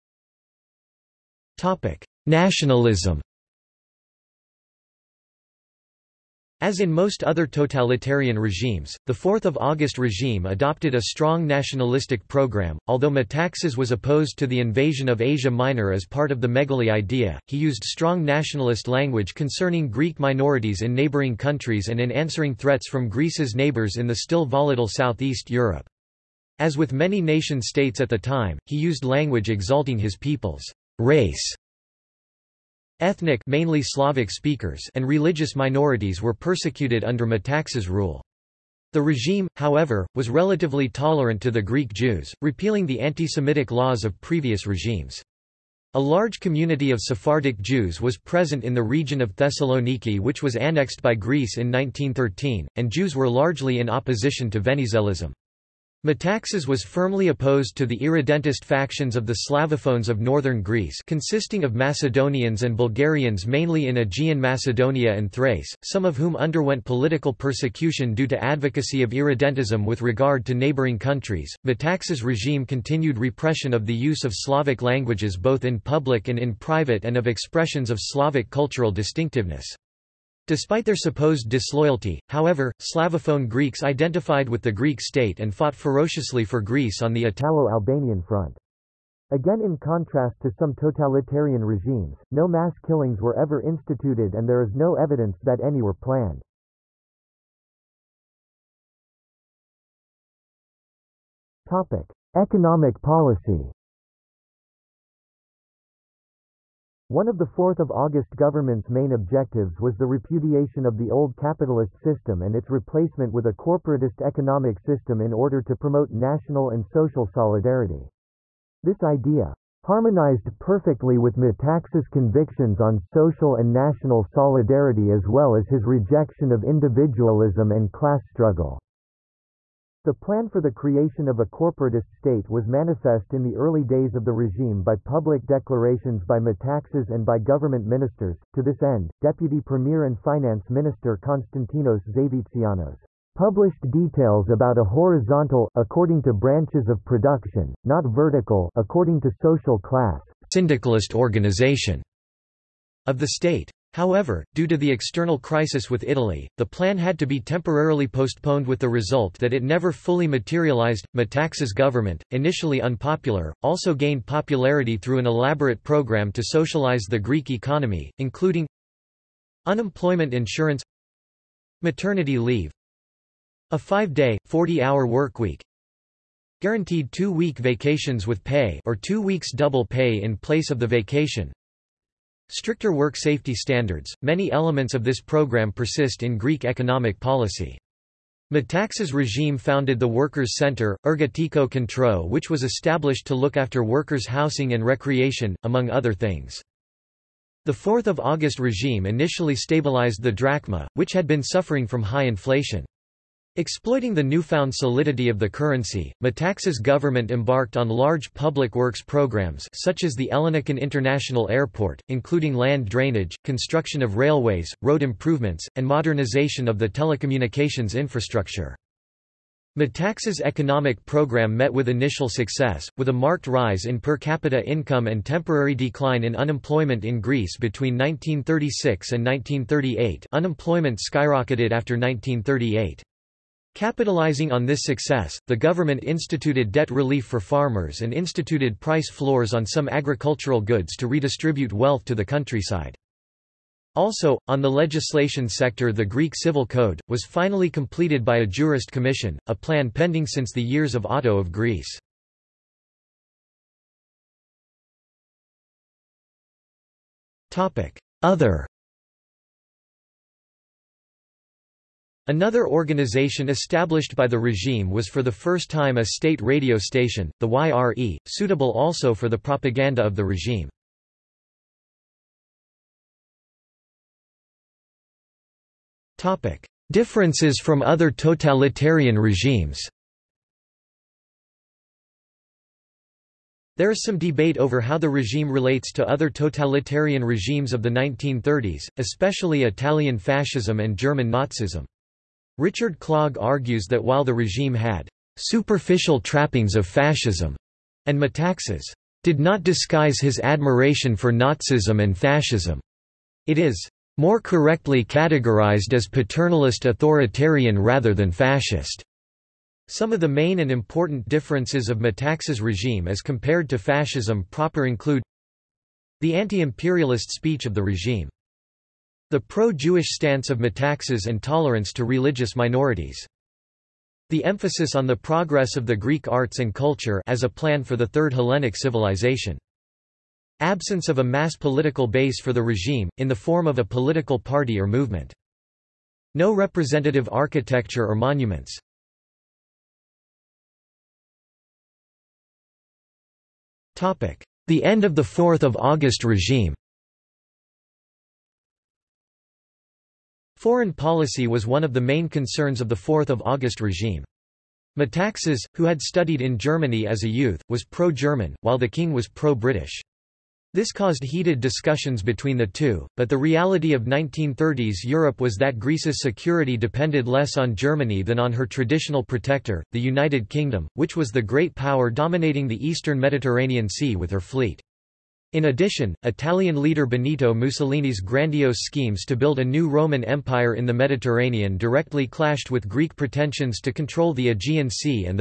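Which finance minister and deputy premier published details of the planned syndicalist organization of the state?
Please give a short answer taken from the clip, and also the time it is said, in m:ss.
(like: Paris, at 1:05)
Konstantinos Zavitsianos, at 2:21.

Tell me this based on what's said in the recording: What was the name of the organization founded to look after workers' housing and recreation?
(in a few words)
Workers' Center (Ergatiko Kentro).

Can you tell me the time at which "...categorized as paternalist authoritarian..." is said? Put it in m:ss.
5:05.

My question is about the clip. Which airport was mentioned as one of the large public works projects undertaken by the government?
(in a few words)
Ellinikon International Airport.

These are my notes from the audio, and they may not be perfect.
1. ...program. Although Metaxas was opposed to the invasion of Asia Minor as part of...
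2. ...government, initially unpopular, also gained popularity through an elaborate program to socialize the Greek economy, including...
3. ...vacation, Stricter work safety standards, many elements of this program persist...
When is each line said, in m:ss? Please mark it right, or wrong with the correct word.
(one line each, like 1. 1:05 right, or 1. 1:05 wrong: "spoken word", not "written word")
1. 0:12 right
2. 2:41 right
3. 3:00 right.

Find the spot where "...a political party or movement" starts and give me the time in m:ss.
5:33.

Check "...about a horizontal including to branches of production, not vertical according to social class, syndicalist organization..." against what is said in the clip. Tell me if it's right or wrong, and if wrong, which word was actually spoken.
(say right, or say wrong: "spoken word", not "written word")
wrong: "according", not "including".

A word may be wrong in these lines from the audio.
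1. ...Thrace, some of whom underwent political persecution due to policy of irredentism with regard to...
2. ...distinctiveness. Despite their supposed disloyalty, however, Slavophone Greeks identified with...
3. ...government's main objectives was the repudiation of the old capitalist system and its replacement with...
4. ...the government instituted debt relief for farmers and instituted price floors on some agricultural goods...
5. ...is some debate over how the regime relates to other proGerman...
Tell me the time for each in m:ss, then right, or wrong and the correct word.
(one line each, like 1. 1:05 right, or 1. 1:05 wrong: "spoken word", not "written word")
1. 1:05 wrong: "advocacy", not "policy"
2. 1:18 right
3. 1:48 right
4. 3:55 right
5. 4:43 wrong: "totalitarian", not "proGerman".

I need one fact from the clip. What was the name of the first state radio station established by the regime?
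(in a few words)
YRE.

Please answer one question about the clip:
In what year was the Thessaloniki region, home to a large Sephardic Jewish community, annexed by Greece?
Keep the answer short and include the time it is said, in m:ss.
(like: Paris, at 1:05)
1913, at 0:51.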